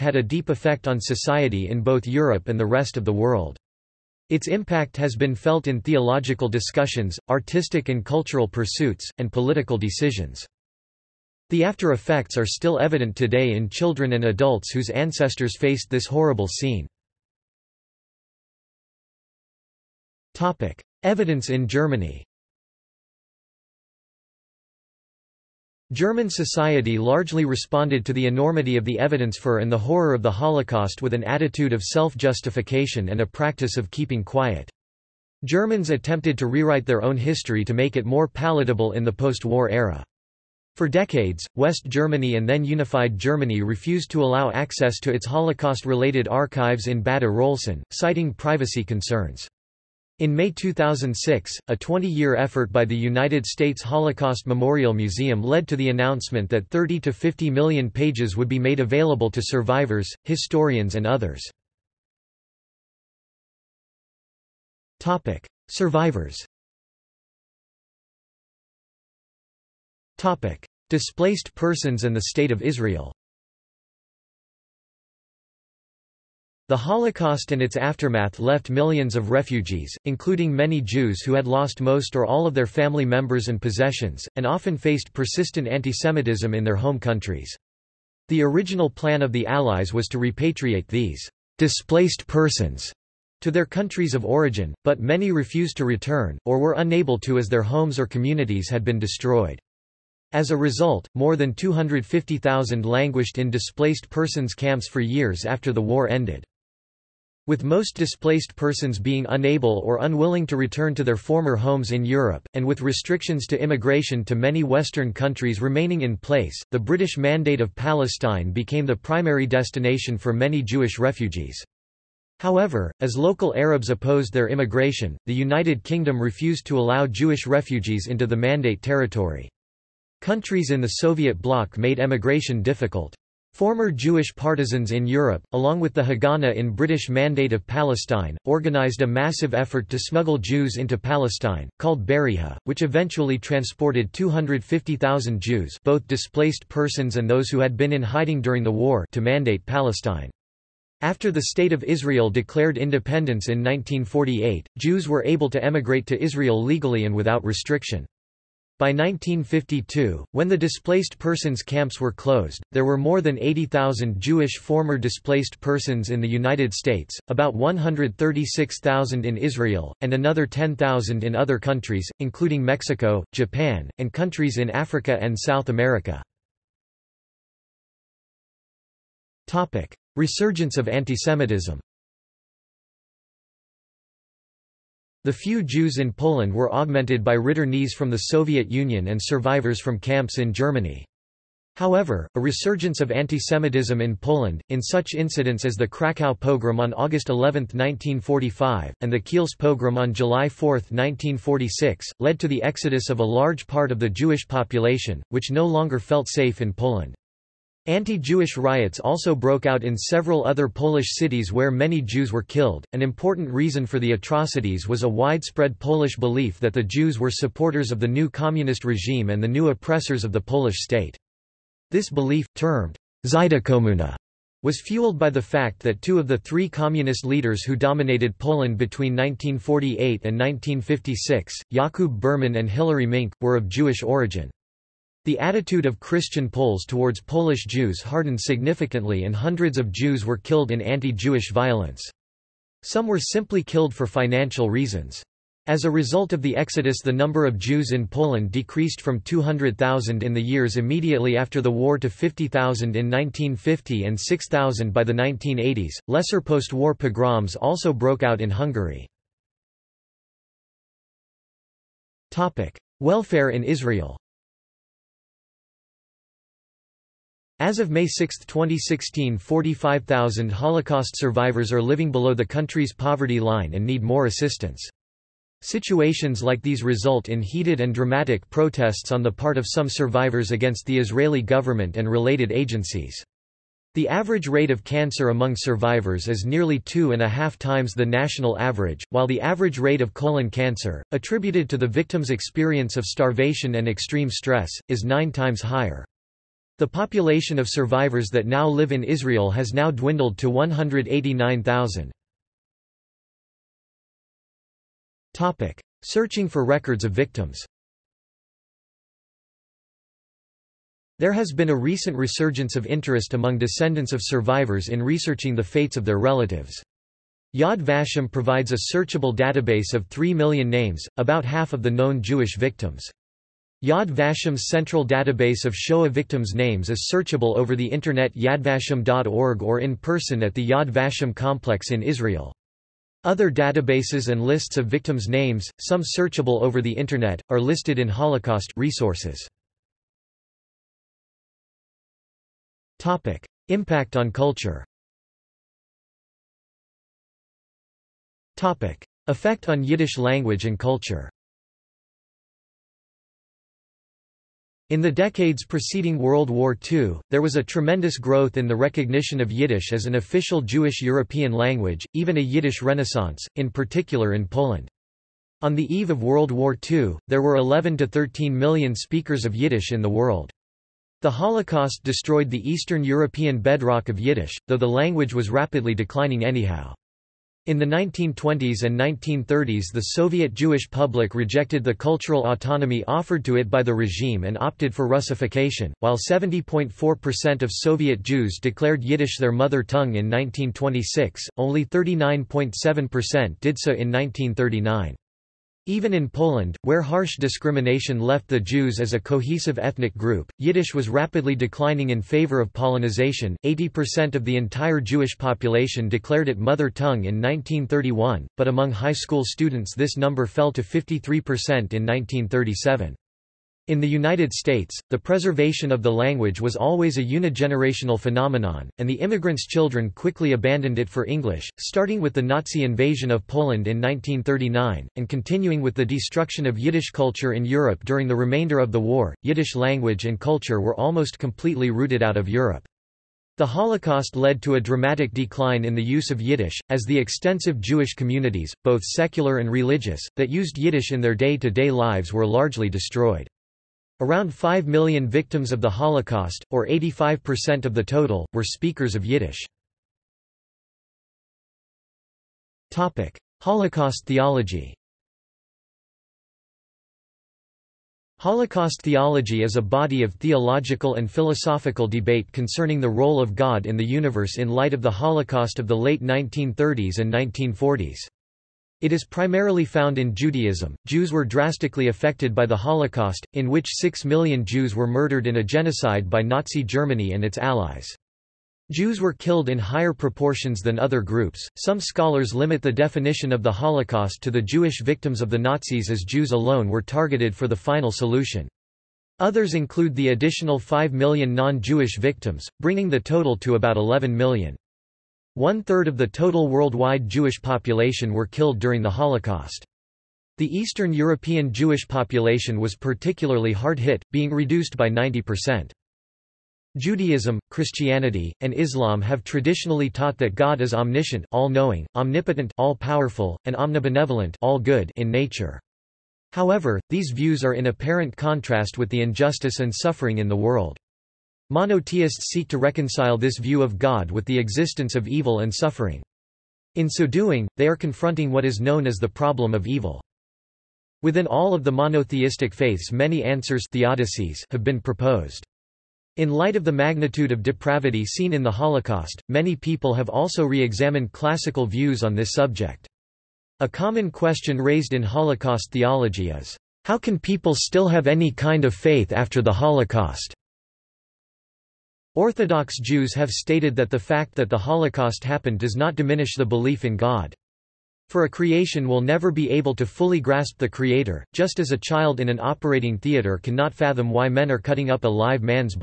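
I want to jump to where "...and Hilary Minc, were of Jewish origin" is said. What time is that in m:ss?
3:52.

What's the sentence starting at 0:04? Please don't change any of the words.
Its impact has been felt in theological discussions, artistic and cultural pursuits, and political decisions.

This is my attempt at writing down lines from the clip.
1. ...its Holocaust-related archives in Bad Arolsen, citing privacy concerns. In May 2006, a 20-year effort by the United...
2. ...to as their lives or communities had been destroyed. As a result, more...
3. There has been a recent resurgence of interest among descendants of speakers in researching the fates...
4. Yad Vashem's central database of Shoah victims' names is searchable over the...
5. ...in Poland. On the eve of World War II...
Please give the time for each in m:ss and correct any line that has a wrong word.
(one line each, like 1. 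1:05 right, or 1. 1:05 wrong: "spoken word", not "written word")
1. 0:45 right
2. 1:37 wrong: "homes", not "lives"
3. 5:11 wrong: "survivors", not "speakers"
4. 5:23 right
5. 6:04 right.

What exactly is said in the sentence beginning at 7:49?
It is primarily found in Judaism.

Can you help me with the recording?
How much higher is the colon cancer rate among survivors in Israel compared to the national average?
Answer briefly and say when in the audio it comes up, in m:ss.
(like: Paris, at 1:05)
9 times, at 4:55.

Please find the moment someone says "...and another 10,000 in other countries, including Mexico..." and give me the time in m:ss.
2:50.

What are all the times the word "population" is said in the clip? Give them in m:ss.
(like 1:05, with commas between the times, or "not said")
3:24, 4:56, 6:45, 8:17, 8:22.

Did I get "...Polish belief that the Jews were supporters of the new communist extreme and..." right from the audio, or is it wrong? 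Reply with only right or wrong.
wrong.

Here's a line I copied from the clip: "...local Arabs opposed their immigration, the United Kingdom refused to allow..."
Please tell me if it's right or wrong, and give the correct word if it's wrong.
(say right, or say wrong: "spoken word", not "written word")
right.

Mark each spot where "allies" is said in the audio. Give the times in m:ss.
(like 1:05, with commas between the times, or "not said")
1:29, 7:57.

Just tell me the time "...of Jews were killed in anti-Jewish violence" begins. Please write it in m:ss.
3:59.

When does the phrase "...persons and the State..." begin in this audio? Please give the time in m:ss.
1:11.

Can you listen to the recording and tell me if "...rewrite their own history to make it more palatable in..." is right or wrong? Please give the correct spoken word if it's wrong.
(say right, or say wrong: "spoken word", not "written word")
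right.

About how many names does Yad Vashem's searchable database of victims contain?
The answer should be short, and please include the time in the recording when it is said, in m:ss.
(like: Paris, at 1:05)
3 million, at 5:20.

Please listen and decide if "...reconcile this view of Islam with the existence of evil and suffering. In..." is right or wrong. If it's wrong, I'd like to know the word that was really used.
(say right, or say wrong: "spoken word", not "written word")
wrong: "God", not "Islam".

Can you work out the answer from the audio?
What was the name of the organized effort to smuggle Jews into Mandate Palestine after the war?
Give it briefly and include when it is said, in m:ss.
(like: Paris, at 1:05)
Berihah, at 2:22.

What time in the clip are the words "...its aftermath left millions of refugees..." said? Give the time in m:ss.
1:17.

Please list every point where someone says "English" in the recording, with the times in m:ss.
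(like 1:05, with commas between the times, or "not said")
7:01.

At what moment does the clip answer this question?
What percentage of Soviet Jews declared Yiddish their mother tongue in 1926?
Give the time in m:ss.
6:26.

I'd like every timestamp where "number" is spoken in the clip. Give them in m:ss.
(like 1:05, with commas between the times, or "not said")
4:07, 6:50.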